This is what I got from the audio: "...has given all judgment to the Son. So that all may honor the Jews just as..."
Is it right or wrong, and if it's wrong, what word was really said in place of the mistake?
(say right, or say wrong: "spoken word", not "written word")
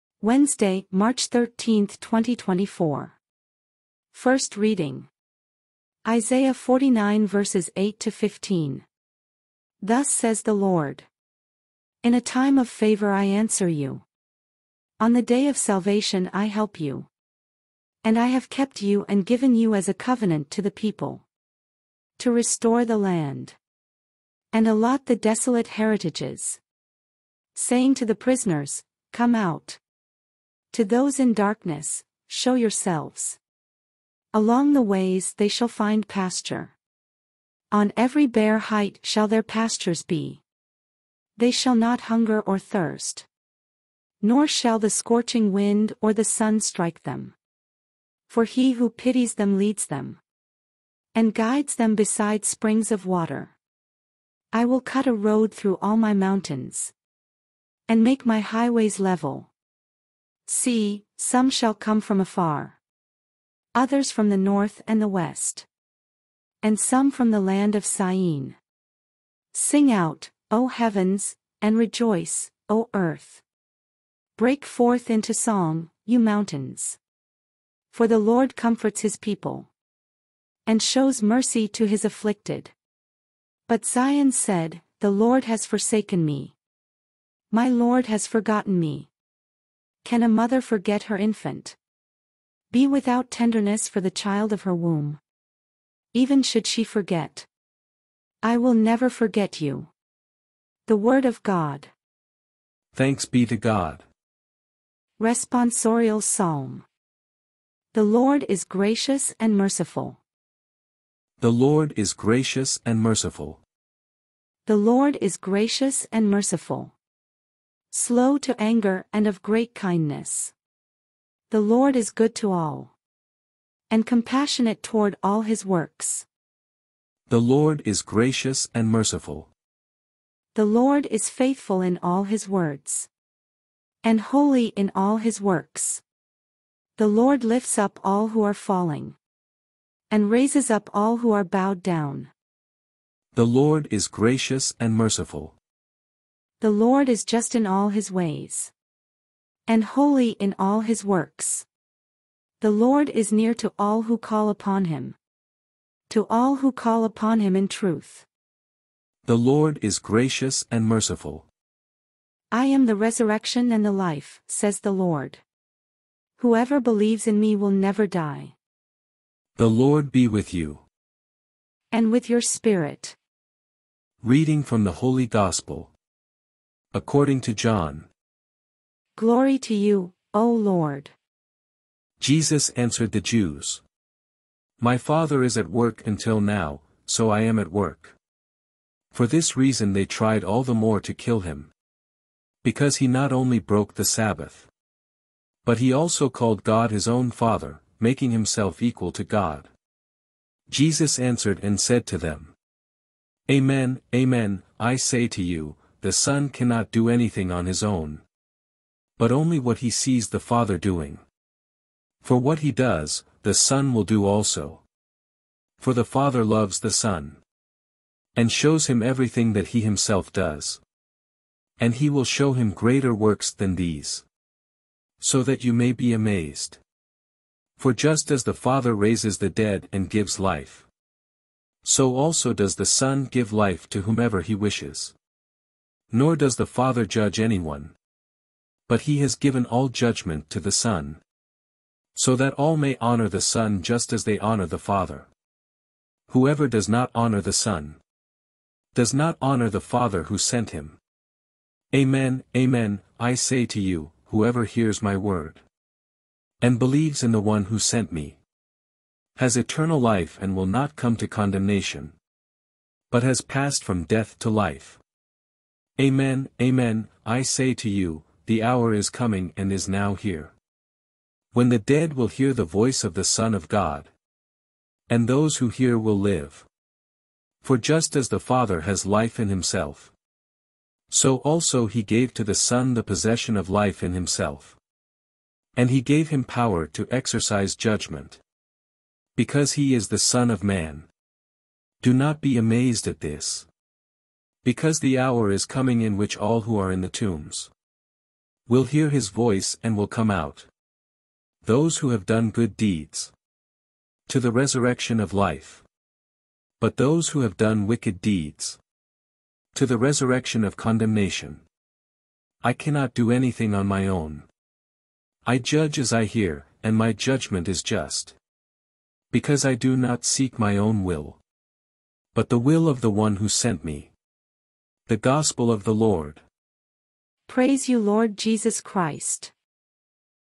wrong: "Son", not "Jews".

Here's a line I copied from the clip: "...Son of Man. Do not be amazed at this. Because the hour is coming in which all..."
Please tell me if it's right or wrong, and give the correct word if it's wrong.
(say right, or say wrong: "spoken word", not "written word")
right.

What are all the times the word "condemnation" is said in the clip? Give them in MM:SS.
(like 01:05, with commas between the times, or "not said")
04:21, 05:10.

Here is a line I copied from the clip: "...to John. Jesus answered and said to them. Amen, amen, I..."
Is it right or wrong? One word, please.
wrong.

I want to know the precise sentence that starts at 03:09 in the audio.
For this reason they tried all the more to kill him.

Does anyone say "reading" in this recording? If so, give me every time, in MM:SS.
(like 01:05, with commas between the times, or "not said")
00:04, 02:54.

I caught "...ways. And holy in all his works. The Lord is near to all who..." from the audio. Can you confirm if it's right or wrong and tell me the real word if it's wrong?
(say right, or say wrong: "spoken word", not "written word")
right.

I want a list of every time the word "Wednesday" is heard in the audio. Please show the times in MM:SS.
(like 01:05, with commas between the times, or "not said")
00:00.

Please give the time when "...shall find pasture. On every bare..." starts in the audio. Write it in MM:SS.
00:35.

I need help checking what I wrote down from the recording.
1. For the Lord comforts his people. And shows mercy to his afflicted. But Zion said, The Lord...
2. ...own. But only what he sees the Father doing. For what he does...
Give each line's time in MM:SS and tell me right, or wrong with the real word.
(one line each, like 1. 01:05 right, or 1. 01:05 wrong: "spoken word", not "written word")
1. 01:17 right
2. 03:27 right.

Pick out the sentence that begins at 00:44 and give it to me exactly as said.
Nor shall the scorching wind or the sun strike them.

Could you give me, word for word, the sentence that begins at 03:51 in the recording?
So also does the Son give life to whomever he wishes.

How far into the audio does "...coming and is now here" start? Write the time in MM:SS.
04:29.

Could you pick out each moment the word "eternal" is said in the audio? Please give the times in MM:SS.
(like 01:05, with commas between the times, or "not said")
04:19.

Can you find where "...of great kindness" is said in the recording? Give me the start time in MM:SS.
01:59.